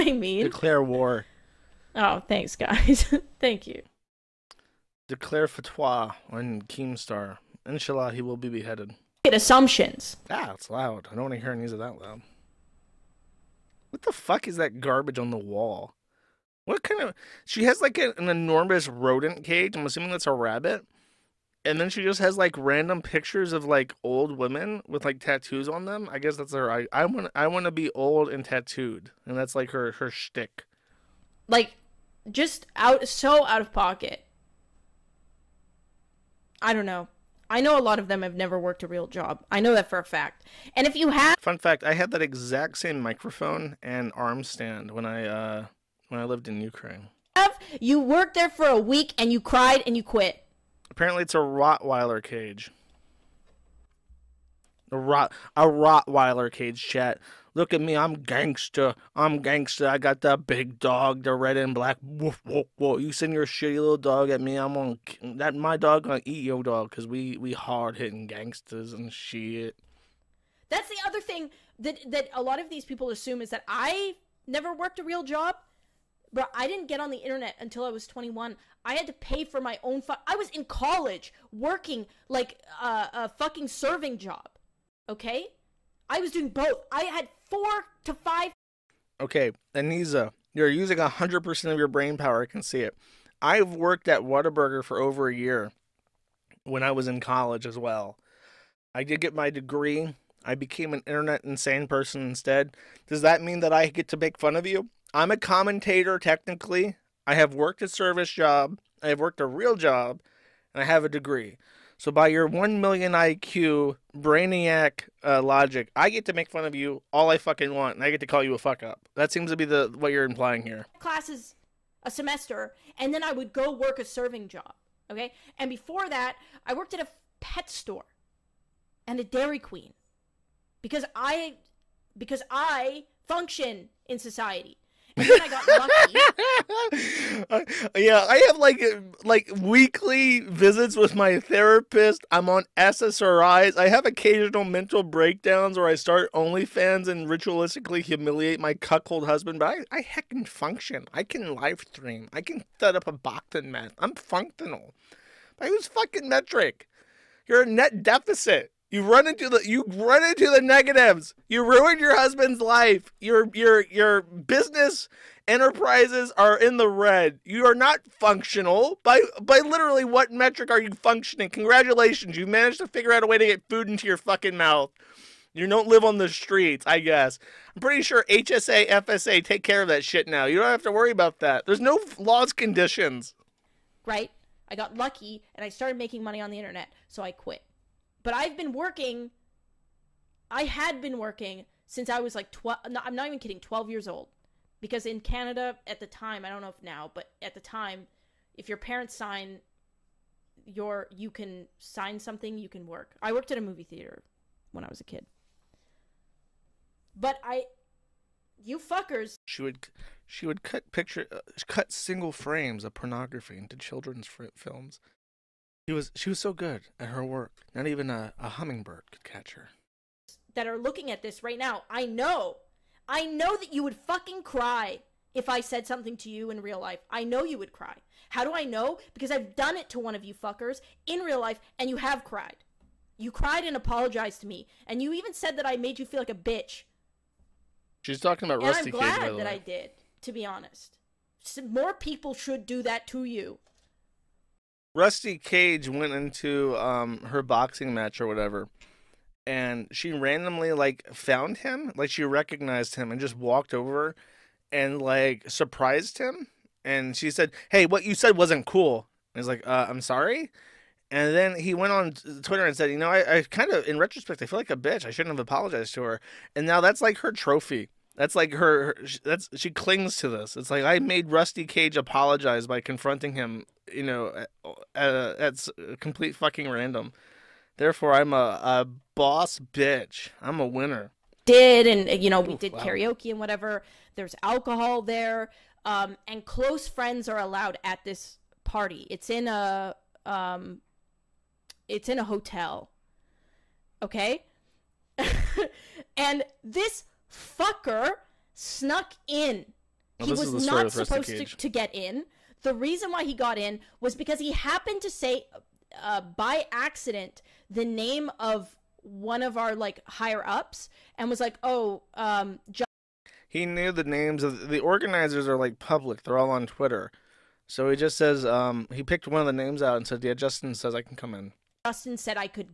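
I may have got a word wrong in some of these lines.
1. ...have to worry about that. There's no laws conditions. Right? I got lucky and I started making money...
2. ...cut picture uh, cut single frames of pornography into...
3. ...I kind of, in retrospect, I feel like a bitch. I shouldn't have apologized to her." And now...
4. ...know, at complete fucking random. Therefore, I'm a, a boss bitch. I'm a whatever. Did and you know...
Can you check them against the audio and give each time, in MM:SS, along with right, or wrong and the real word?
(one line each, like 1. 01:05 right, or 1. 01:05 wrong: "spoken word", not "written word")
1. 03:00 right
2. 03:30 right
3. 04:23 right
4. 04:34 wrong: "winner", not "whatever".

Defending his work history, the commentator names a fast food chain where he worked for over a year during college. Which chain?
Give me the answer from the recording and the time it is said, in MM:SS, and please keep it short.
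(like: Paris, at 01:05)
Whataburger, at 01:34.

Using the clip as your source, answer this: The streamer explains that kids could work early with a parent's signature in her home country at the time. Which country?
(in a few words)
Canada.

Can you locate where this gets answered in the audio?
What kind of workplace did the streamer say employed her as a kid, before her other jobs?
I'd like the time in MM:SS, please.
03:23.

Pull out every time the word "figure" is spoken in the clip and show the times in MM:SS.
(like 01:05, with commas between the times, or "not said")
02:52.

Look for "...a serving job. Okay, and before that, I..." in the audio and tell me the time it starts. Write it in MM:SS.
02:03.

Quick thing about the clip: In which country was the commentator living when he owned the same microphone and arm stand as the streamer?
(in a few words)
Ukraine.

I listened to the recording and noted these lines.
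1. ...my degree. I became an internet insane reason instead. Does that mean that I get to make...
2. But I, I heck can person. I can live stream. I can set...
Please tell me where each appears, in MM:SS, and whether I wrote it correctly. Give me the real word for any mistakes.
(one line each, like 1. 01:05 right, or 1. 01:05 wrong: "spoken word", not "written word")
1. 01:39 wrong: "person", not "reason"
2. 02:29 wrong: "function", not "person".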